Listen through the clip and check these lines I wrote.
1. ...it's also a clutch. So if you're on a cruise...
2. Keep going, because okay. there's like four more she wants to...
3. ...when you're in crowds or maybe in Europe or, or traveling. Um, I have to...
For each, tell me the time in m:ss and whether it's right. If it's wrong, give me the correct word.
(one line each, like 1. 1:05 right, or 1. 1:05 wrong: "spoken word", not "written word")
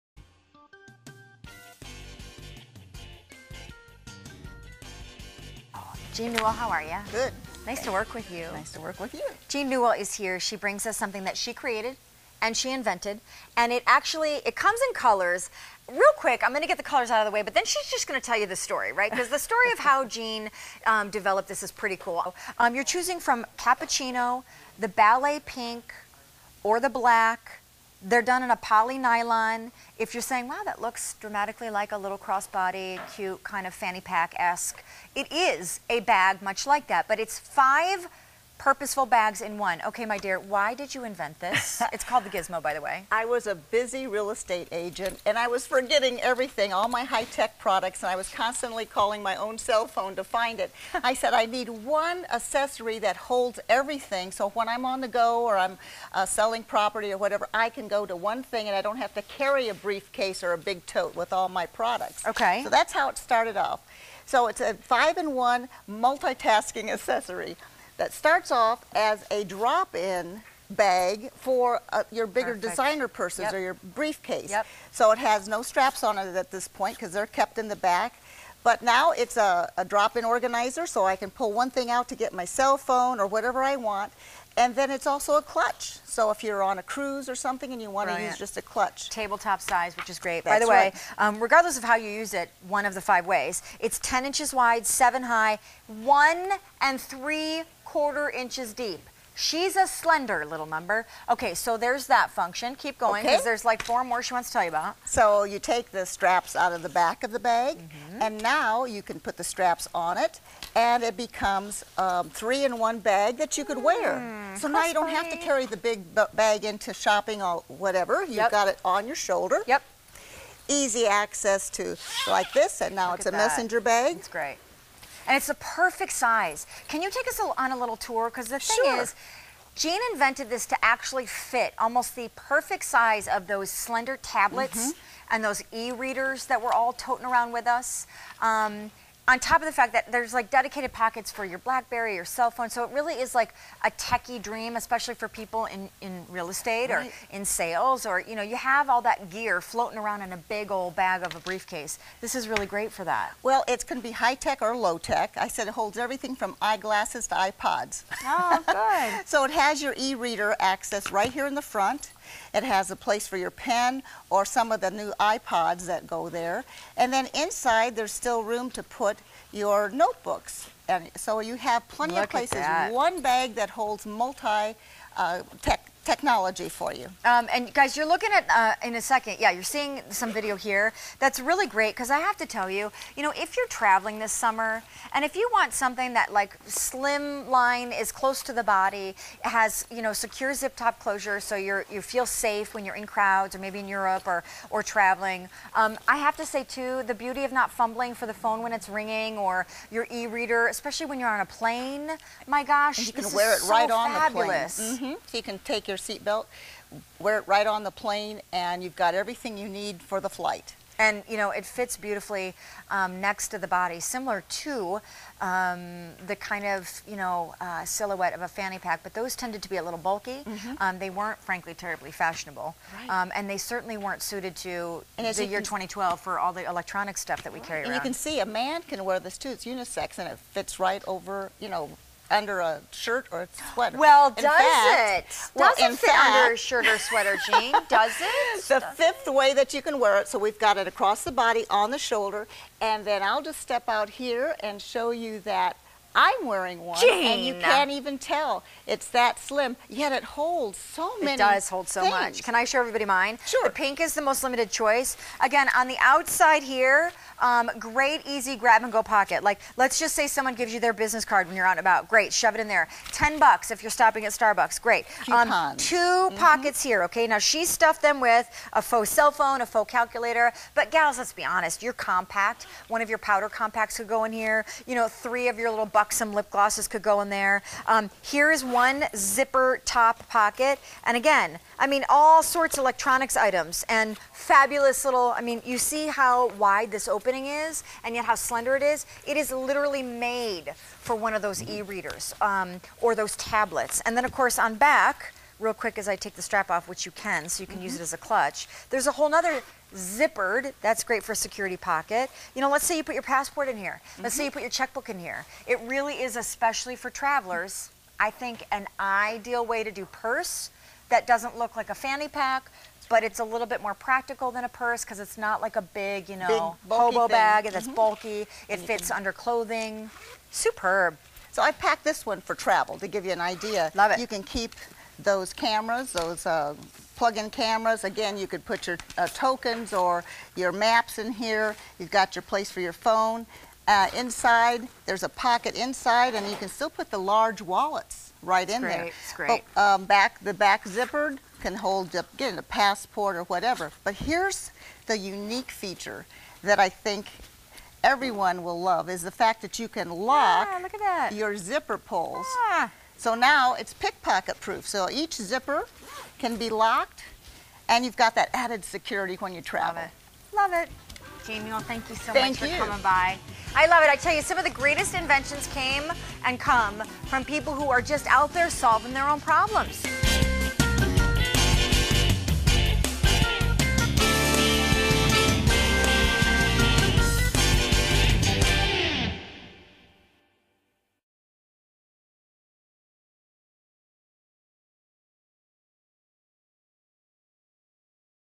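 1. 1:24 right
2. 1:42 right
3. 3:12 right.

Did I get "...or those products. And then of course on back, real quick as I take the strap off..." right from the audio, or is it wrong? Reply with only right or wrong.
wrong.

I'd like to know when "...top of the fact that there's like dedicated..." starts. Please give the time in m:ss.
2:19.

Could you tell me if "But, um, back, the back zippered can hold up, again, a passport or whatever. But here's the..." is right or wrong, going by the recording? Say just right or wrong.
right.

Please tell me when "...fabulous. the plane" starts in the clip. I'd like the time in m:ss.
3:24.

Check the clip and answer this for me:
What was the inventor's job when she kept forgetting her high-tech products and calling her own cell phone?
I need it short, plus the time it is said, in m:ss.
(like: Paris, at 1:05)
Real estate agent, at 0:44.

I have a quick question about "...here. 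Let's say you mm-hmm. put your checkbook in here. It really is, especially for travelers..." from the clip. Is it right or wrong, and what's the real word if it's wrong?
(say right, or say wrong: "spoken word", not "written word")
right.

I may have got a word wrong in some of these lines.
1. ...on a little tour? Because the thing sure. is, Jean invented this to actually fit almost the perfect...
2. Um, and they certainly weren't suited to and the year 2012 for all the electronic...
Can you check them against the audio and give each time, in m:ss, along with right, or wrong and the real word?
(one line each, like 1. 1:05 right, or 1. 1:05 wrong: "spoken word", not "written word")
1. 2:07 right
2. 3:43 right.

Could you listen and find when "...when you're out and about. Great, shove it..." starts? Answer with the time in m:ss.
4:21.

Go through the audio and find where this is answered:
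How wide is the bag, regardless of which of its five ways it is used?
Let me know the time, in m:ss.
1:33.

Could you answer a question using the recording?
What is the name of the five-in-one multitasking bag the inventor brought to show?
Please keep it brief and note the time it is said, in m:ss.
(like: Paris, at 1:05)
The Gizmo, at 0:41.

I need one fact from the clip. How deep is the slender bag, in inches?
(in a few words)
1 and 3/4 inches.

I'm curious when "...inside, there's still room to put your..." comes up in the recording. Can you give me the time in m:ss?
2:47.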